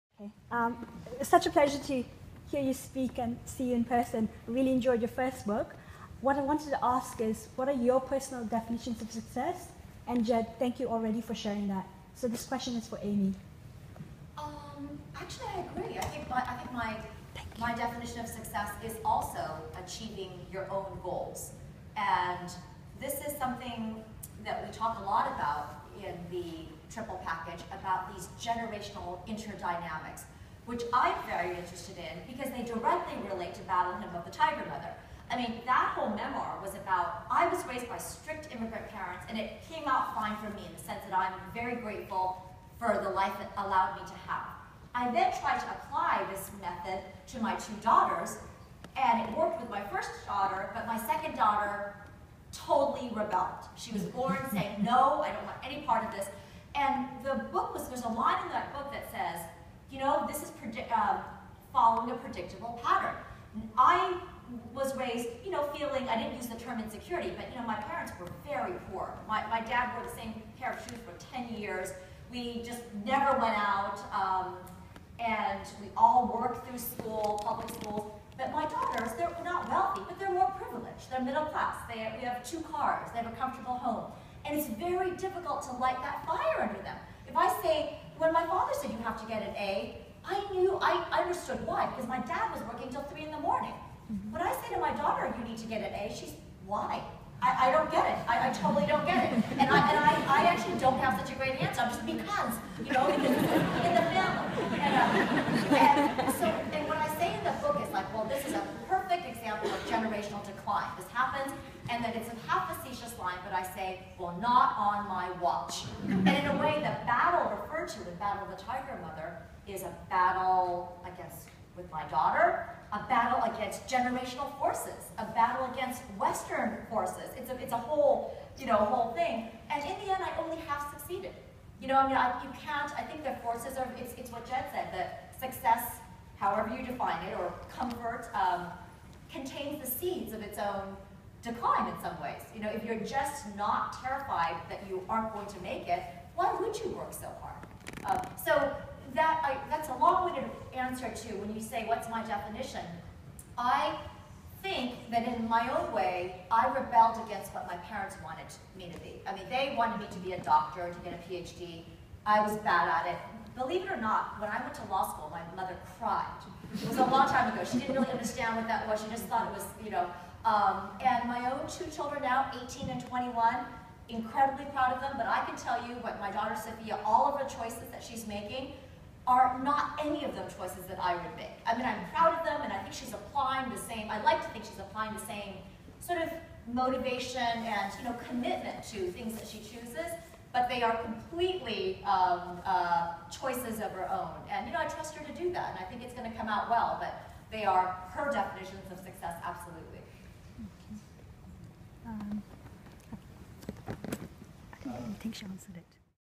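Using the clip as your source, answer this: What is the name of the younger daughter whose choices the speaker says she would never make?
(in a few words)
Sophia.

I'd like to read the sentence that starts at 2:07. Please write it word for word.
It's a, it's a whole, you know, whole thing.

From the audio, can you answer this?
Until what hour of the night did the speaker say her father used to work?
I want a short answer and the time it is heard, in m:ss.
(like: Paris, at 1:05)
3 in the morning, at 1:33.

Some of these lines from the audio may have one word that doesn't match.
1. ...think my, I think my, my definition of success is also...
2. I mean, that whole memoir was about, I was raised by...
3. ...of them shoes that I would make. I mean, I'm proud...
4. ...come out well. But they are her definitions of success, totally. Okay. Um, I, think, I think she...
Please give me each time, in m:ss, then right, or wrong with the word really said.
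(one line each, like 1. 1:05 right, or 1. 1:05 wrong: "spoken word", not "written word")
1. 0:16 right
2. 0:35 right
3. 3:00 wrong: "choices", not "shoes"
4. 3:16 wrong: "absolutely", not "totally".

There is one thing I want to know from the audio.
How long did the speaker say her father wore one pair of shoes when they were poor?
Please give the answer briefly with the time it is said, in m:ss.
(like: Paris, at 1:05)
10 years, at 1:11.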